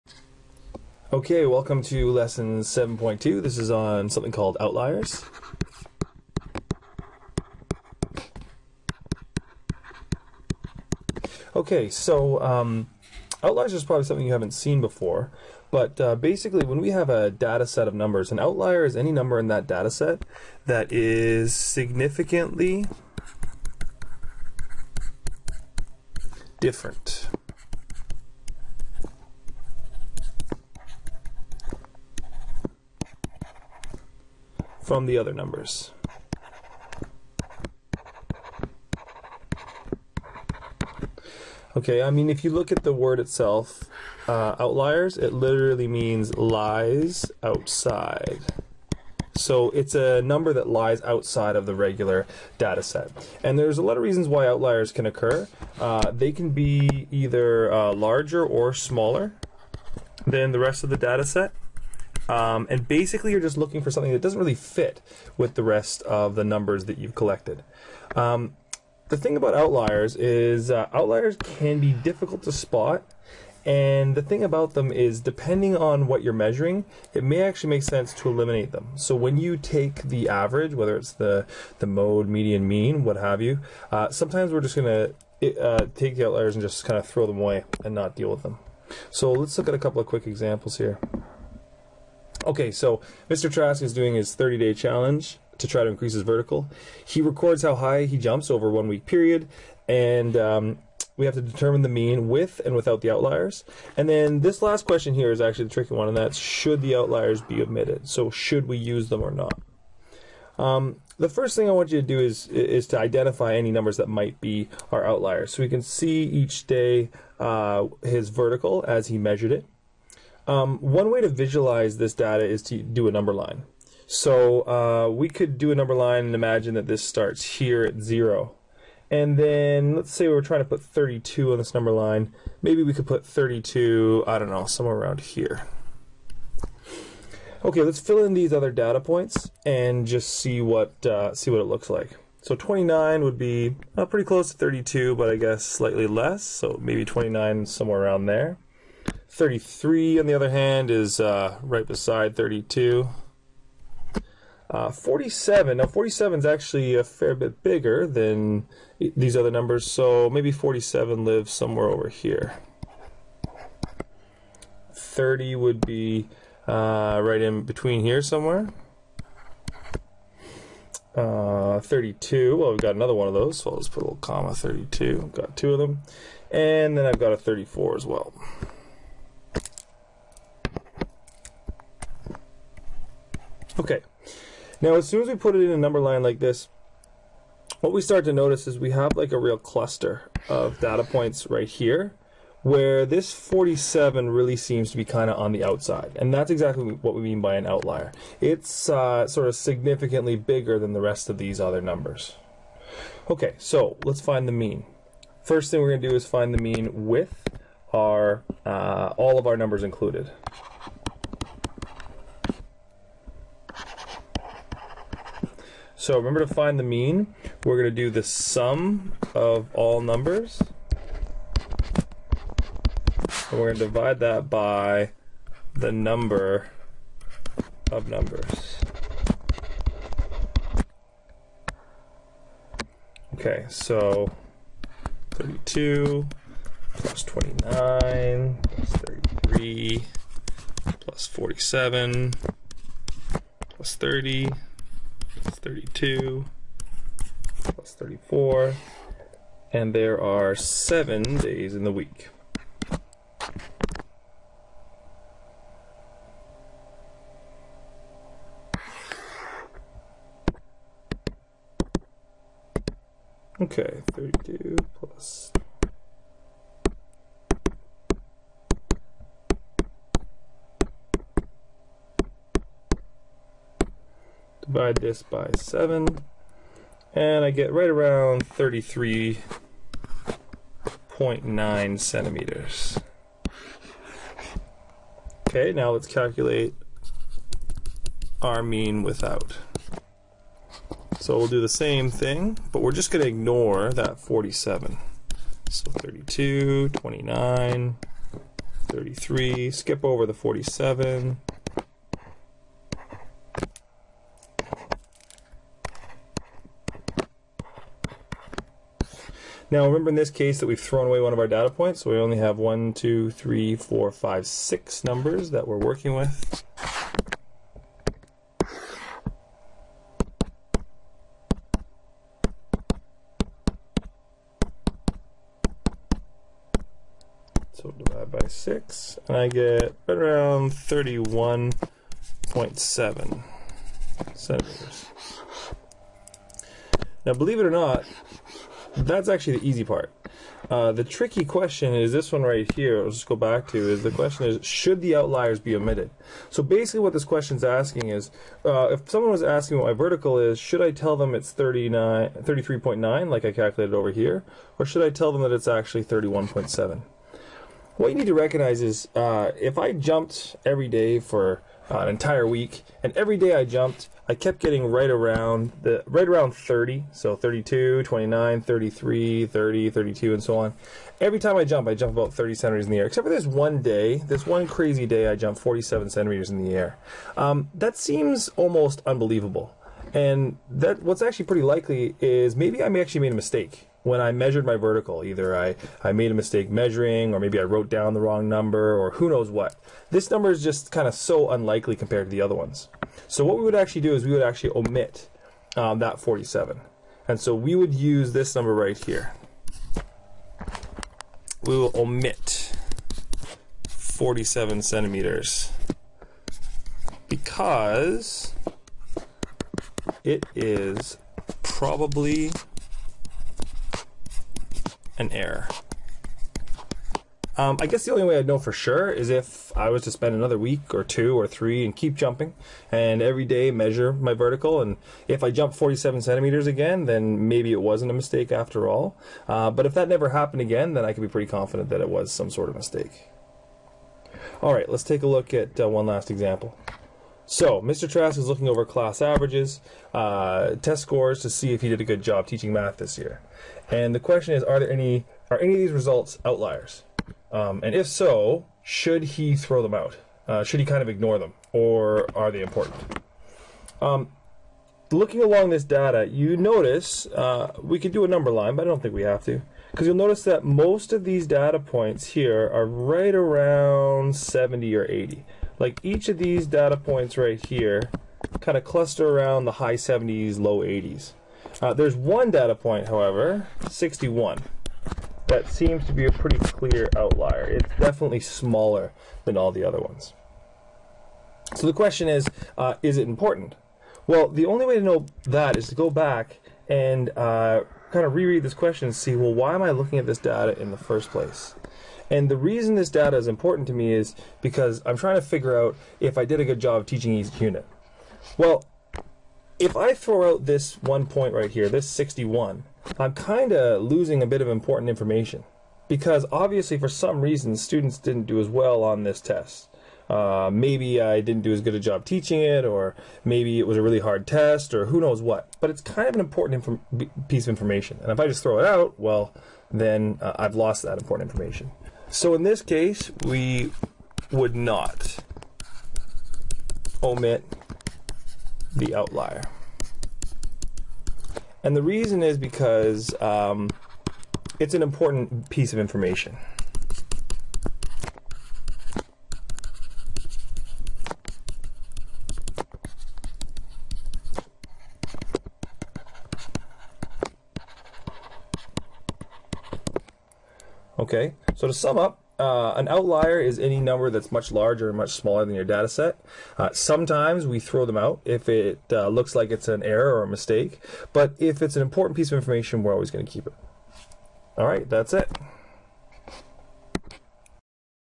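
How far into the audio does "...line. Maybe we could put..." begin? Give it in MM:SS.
02:11.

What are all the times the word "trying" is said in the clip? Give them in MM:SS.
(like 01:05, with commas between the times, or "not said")
02:10, 08:15.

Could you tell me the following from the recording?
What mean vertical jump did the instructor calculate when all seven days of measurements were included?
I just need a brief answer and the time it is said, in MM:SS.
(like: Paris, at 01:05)
33.9 centimeters, at 04:38.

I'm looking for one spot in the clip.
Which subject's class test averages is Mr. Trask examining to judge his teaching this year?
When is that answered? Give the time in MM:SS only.
07:22.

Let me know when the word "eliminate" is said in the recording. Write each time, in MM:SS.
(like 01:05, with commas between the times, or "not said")
01:18.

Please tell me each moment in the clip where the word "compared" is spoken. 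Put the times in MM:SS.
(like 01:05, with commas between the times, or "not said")
06:31.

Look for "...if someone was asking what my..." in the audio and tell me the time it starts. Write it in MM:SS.
05:48.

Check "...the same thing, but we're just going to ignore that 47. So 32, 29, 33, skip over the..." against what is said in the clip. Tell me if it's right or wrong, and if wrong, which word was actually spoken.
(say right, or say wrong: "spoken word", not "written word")
right.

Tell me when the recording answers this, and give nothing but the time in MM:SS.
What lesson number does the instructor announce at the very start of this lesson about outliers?
00:02.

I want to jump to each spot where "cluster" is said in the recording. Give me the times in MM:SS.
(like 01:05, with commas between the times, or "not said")
03:09, 07:48.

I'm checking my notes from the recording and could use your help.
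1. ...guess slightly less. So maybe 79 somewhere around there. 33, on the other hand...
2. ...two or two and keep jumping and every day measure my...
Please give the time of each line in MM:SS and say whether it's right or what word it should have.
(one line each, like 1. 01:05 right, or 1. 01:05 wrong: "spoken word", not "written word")
1. 02:25 wrong: "29", not "79"
2. 07:01 wrong: "three", not "two".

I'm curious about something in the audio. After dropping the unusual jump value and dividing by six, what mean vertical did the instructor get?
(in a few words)
31.7 centimeters.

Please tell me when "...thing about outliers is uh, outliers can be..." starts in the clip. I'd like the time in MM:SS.
01:09.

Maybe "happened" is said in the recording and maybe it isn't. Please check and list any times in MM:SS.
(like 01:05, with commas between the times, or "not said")
07:10.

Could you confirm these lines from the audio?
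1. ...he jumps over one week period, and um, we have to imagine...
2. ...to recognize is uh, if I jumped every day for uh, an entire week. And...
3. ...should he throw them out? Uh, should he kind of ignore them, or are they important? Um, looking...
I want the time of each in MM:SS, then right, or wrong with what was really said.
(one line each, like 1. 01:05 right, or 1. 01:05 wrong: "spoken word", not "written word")
1. 01:38 wrong: "determine", not "imagine"
2. 05:58 right
3. 07:28 right.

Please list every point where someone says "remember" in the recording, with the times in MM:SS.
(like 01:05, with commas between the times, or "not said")
03:36, 05:09.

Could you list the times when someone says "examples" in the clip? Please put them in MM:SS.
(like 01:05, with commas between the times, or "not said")
01:30, 07:16.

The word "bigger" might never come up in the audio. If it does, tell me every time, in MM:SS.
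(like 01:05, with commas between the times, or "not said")
02:37, 03:20.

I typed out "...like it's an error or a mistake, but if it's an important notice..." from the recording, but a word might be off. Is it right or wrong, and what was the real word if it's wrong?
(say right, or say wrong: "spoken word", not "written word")
wrong: "piece", not "notice".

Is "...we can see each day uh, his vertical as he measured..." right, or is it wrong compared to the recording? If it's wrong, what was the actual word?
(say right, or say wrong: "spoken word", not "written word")
right.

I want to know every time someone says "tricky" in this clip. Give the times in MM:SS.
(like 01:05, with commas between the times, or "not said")
01:45, 05:41.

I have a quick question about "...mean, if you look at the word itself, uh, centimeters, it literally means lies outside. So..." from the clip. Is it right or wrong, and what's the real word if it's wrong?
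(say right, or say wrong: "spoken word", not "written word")
wrong: "outliers", not "centimeters".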